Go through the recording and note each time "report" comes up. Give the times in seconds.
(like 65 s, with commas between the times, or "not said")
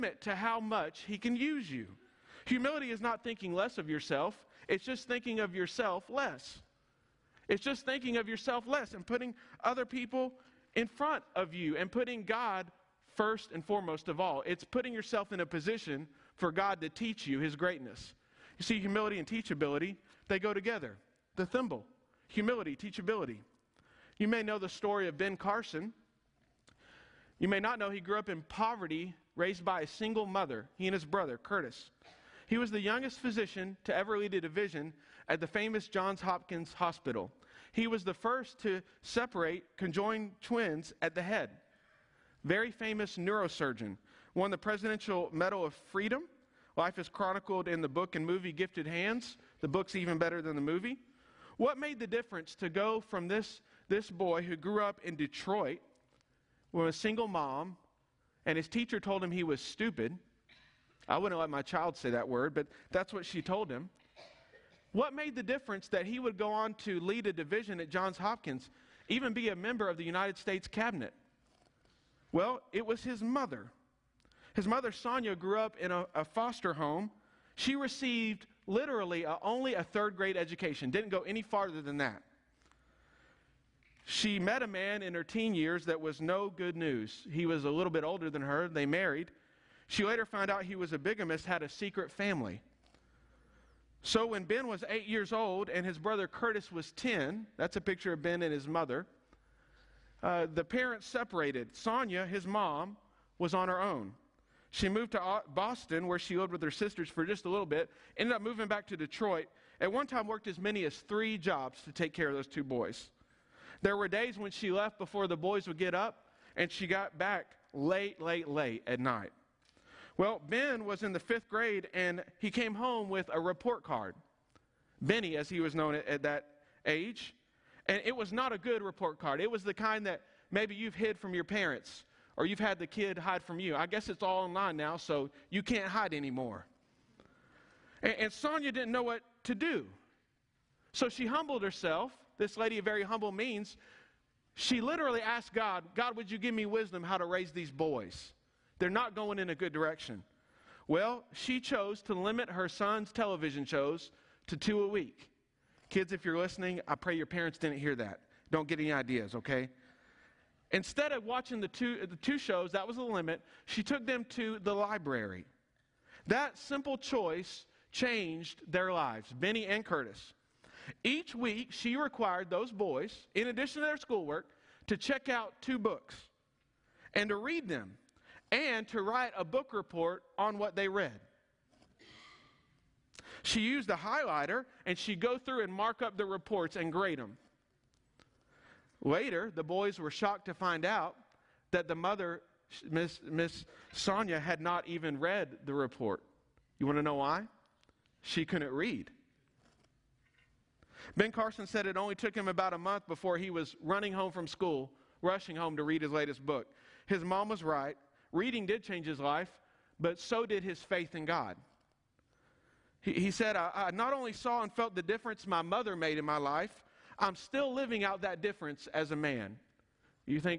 123 s, 128 s, 179 s, 186 s, 195 s.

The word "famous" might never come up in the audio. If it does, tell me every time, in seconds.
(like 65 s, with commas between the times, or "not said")
35 s, 42 s.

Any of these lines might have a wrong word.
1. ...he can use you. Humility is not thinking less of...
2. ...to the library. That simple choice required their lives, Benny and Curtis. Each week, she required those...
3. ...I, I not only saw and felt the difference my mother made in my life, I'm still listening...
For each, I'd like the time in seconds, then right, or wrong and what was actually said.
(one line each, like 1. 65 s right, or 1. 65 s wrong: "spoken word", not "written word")
1. 1 s right
2. 164 s wrong: "changed", not "required"
3. 213 s wrong: "living", not "listening".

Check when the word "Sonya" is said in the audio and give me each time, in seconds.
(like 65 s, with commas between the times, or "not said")
74 s, 101 s, 138 s, 193 s.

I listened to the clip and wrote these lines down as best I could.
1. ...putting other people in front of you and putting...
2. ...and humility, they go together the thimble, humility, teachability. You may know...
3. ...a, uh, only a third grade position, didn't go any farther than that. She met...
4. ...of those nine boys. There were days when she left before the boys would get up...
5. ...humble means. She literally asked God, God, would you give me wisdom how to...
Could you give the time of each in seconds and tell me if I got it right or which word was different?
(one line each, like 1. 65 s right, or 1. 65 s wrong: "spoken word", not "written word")
1. 9 s right
2. 19 s wrong: "teachability", not "humility"
3. 79 s wrong: "education", not "position"
4. 112 s wrong: "two", not "nine"
5. 143 s right.